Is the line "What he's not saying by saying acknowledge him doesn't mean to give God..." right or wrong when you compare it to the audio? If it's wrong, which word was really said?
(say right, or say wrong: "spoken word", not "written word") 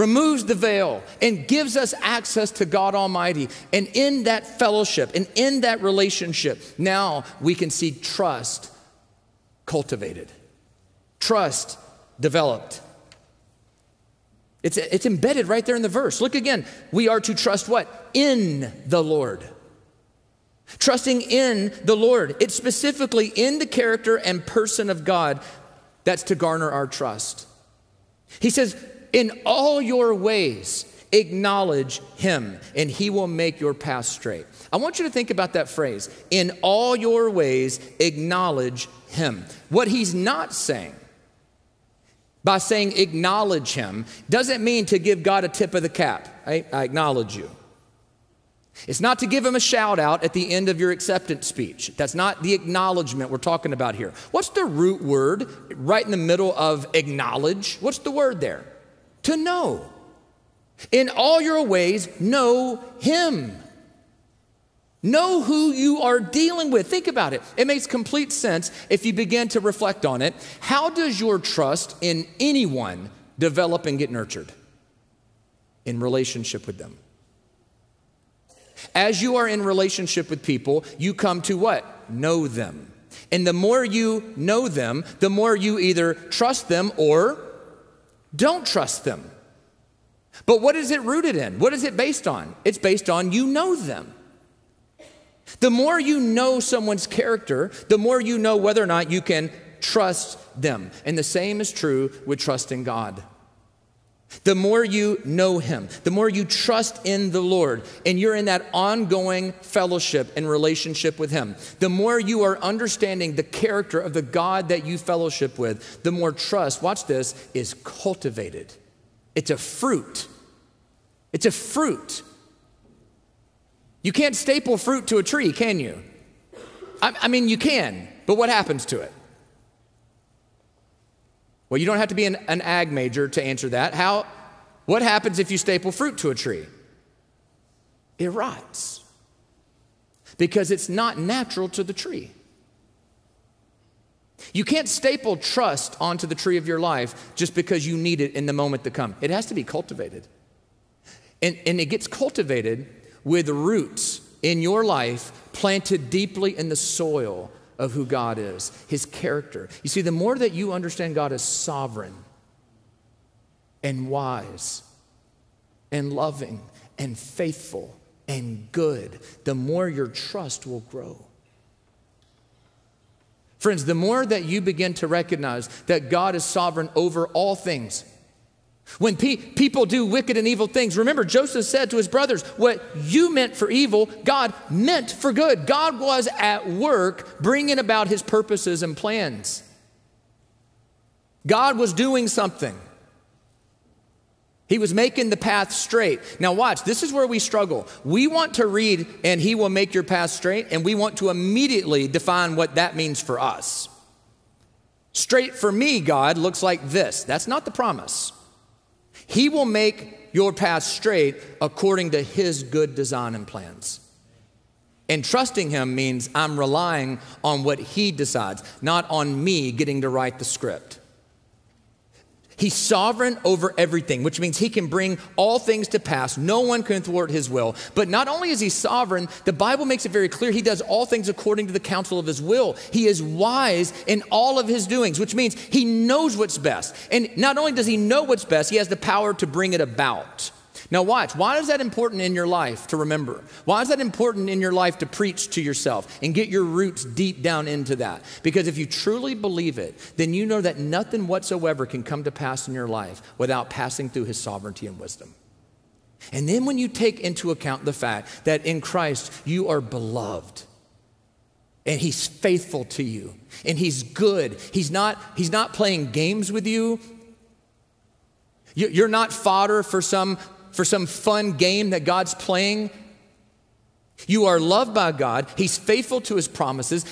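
right.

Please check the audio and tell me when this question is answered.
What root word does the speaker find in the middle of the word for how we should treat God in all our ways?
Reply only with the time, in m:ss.
0:59.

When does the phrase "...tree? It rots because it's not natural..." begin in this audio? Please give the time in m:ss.
2:16.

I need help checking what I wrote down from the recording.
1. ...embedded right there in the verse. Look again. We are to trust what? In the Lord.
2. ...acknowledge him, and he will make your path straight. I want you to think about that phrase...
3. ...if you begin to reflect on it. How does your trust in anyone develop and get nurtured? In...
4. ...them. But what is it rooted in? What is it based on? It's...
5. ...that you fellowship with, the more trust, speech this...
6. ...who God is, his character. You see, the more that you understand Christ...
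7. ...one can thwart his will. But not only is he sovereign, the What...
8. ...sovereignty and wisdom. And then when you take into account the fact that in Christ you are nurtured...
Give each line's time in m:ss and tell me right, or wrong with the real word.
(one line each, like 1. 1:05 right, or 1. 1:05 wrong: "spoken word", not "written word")
1. 0:15 right
2. 0:31 right
3. 1:08 right
4. 1:29 right
5. 1:54 wrong: "watch", not "speech"
6. 2:37 wrong: "God", not "Christ"
7. 3:46 wrong: "Bible", not "What"
8. 4:14 wrong: "beloved", not "nurtured".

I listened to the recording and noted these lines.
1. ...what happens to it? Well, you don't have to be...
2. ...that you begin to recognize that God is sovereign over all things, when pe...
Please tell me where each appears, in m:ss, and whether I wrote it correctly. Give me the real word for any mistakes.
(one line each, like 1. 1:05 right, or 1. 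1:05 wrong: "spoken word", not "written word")
1. 2:08 right
2. 2:54 right.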